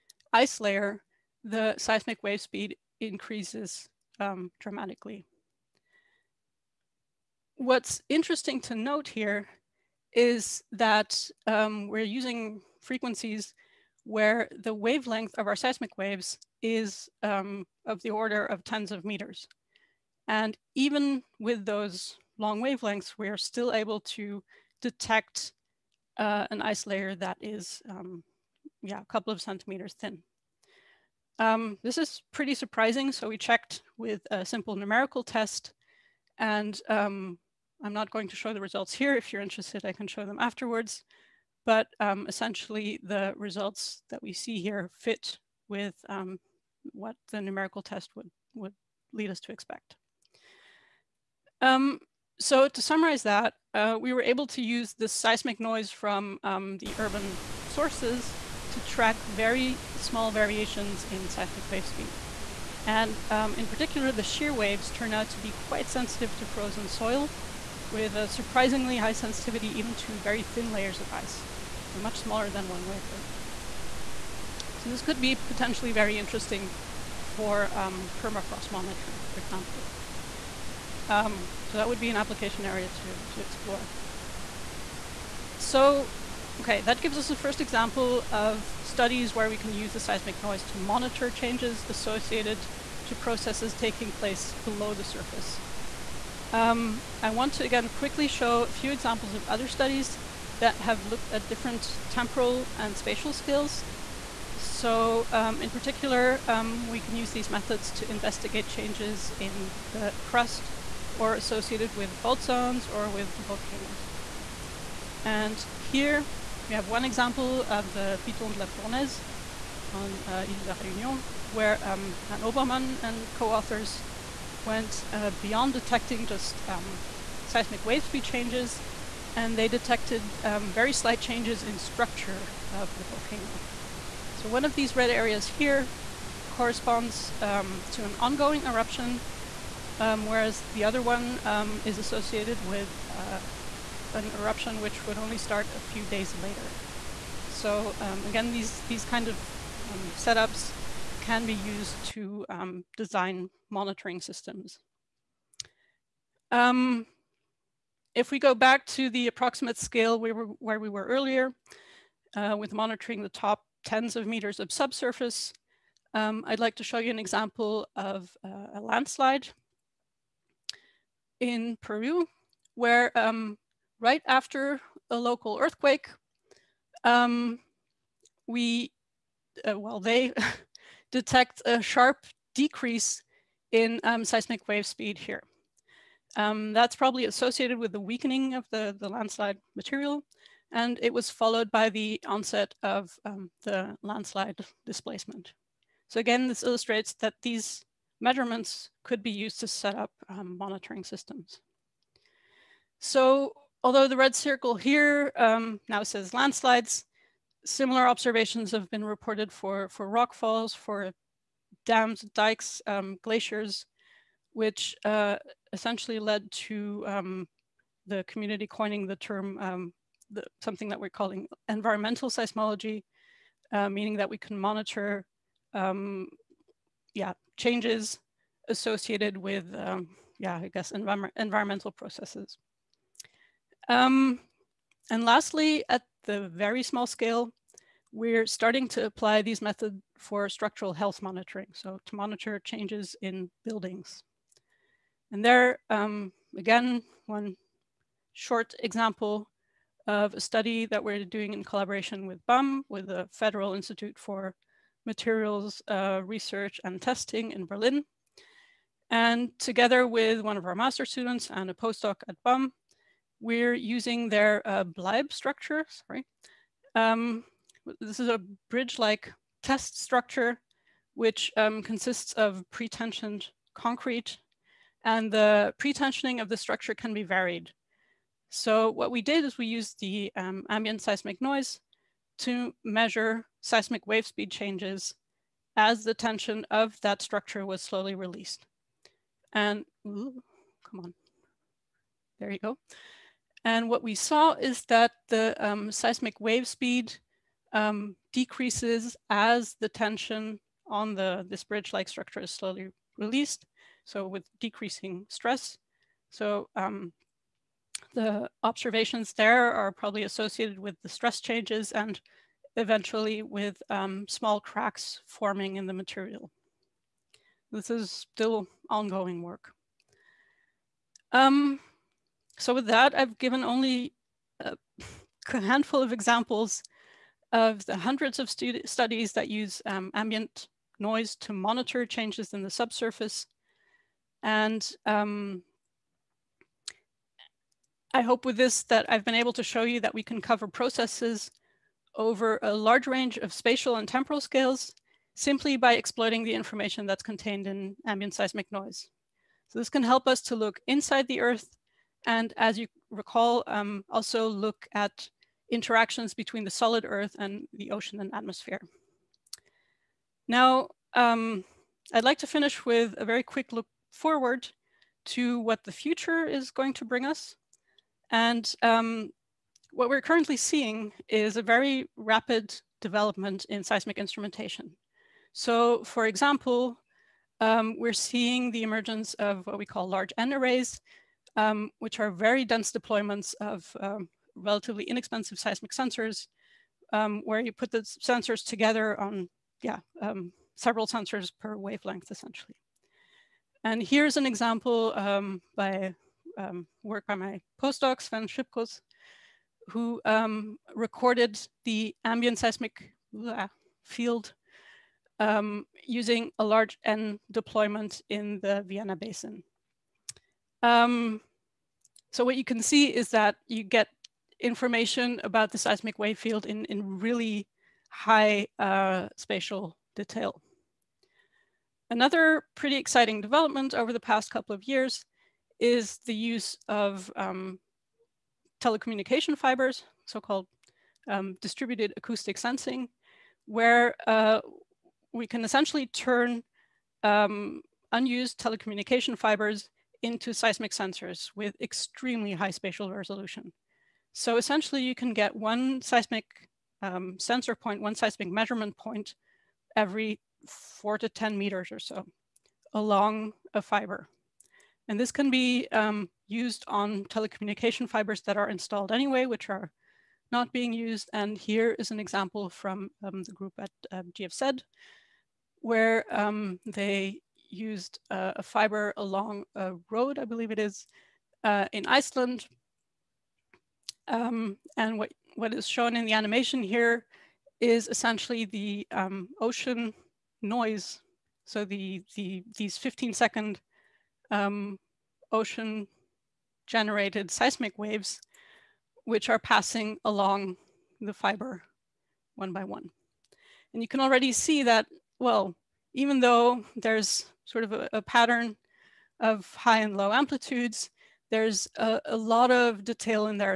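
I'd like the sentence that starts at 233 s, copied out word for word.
Um, and lastly, at the very small scale, we're starting to apply these methods for structural health monitoring.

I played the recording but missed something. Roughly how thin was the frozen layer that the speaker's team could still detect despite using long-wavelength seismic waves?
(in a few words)
A couple of centimeters.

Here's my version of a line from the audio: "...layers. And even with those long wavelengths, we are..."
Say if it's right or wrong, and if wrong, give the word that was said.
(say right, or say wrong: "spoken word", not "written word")
wrong: "meters", not "layers".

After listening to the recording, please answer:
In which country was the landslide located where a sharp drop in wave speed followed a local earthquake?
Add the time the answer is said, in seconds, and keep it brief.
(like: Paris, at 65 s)
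Peru, at 171 s.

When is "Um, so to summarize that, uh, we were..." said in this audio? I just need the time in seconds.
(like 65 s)
51 s.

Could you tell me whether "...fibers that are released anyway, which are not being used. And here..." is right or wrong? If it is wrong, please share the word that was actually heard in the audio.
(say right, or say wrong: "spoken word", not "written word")
wrong: "installed", not "released".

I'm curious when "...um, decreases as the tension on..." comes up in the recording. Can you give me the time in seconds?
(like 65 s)
297 s.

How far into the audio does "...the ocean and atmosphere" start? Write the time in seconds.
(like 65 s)
357 s.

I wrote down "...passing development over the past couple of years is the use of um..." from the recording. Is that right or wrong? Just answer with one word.
wrong.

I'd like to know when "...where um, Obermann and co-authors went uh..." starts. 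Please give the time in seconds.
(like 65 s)
121 s.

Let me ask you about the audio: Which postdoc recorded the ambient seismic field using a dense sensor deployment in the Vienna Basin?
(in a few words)
Sven Schippkus.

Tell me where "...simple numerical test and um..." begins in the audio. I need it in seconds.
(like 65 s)
34 s.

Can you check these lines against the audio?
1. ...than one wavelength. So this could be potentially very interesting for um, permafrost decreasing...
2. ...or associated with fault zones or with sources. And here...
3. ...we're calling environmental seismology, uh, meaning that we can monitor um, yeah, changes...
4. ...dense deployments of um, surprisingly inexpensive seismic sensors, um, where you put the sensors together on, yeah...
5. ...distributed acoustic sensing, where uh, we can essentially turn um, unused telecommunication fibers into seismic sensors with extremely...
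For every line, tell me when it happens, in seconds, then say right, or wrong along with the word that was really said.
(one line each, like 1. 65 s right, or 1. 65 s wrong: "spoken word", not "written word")
1. 72 s wrong: "monitoring", not "decreasing"
2. 111 s wrong: "volcanoes", not "sources"
3. 220 s right
4. 382 s wrong: "relatively", not "surprisingly"
5. 431 s right.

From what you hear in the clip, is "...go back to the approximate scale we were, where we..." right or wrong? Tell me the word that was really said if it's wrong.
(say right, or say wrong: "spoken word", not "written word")
right.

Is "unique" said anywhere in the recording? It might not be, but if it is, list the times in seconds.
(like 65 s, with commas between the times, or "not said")
not said.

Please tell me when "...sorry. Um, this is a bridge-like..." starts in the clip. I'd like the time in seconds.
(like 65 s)
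265 s.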